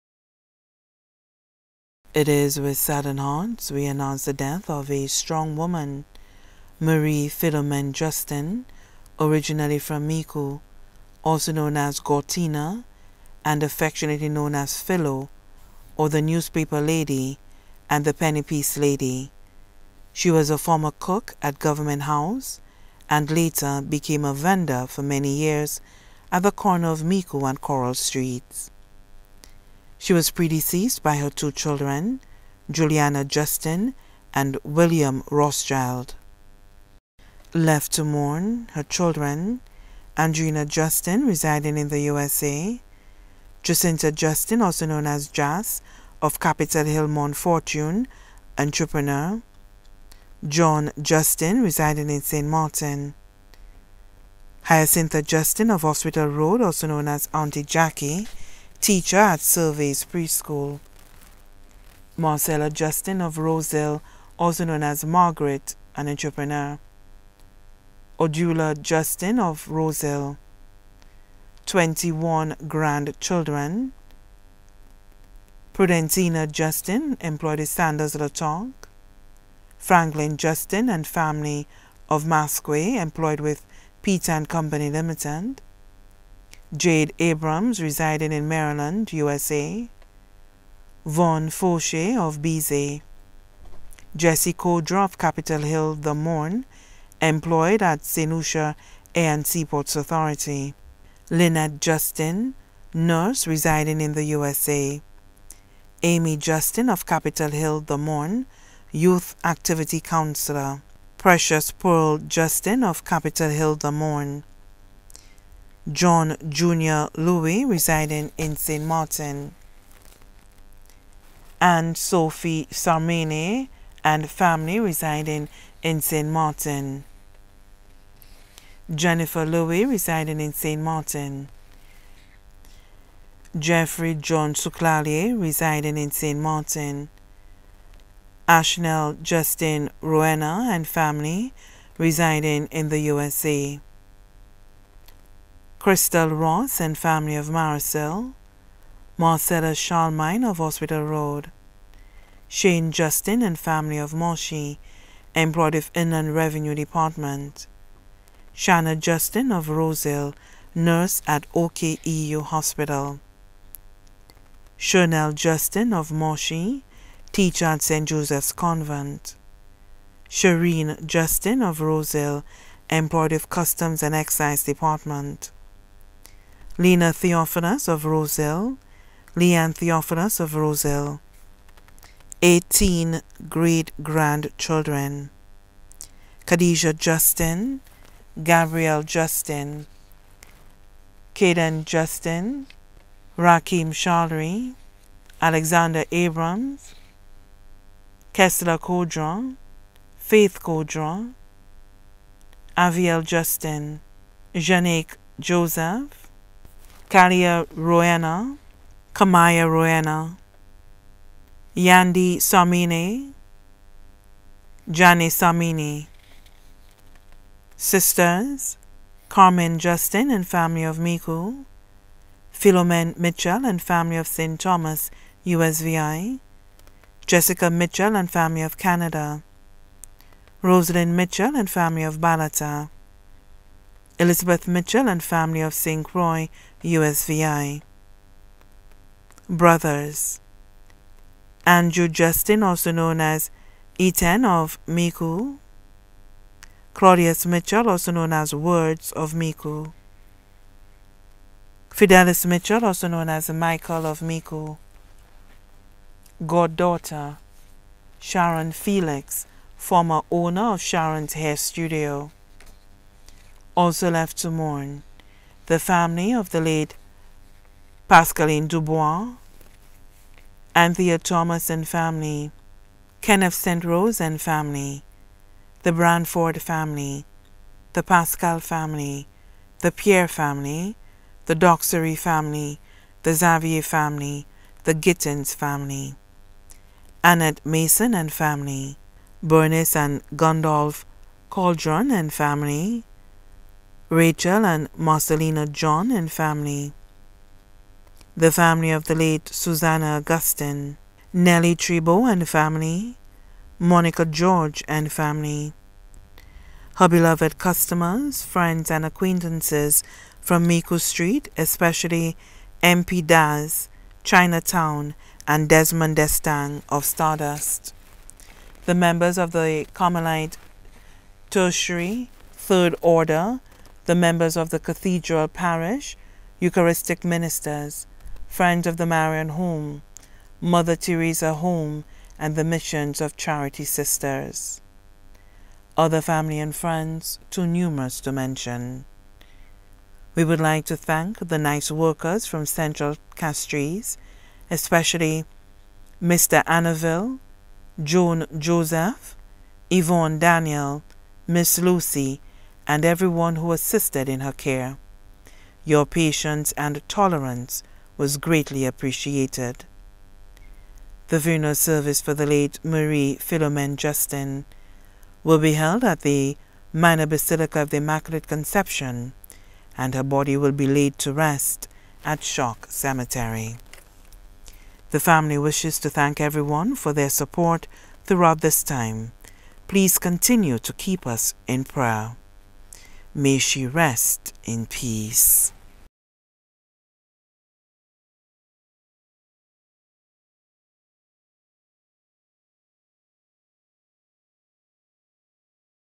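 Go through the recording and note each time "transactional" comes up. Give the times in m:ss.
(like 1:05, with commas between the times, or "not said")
not said.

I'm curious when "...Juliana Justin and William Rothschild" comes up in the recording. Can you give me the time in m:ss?
0:32.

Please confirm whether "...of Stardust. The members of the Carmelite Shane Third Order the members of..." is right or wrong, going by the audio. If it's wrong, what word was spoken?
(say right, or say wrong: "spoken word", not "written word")
wrong: "Tertiary", not "Shane".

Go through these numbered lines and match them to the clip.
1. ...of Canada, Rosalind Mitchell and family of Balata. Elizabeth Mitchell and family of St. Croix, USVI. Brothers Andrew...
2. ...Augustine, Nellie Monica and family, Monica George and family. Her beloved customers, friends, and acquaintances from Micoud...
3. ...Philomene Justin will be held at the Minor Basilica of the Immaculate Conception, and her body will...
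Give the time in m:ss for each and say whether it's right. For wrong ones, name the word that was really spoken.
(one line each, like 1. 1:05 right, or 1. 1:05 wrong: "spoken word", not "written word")
1. 3:48 right
2. 5:00 wrong: "Trebo", not "Monica"
3. 6:03 right.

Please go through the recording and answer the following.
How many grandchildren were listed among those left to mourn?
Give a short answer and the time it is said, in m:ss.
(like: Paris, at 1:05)
21, at 1:11.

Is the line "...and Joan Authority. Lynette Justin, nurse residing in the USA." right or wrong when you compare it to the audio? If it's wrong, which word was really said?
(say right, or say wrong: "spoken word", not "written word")
wrong: "Seaports", not "Joan".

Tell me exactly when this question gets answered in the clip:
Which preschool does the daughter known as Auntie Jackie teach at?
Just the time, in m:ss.
0:59.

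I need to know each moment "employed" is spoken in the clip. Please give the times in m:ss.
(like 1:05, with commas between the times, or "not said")
1:17, 1:22, 1:37, 2:35, 2:52.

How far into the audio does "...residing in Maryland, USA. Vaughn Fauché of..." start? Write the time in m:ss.
1:27.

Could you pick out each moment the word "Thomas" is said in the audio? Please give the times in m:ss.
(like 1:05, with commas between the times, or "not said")
3:44, 4:31.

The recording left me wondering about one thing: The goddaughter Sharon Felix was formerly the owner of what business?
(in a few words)
Sharon's Hair Studio.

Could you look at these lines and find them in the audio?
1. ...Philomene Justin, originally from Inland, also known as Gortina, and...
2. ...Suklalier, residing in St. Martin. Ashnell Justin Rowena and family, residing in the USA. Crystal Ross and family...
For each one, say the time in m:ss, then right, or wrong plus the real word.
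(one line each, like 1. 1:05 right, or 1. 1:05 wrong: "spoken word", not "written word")
1. 0:07 wrong: "Micoud", not "Inland"
2. 2:14 right.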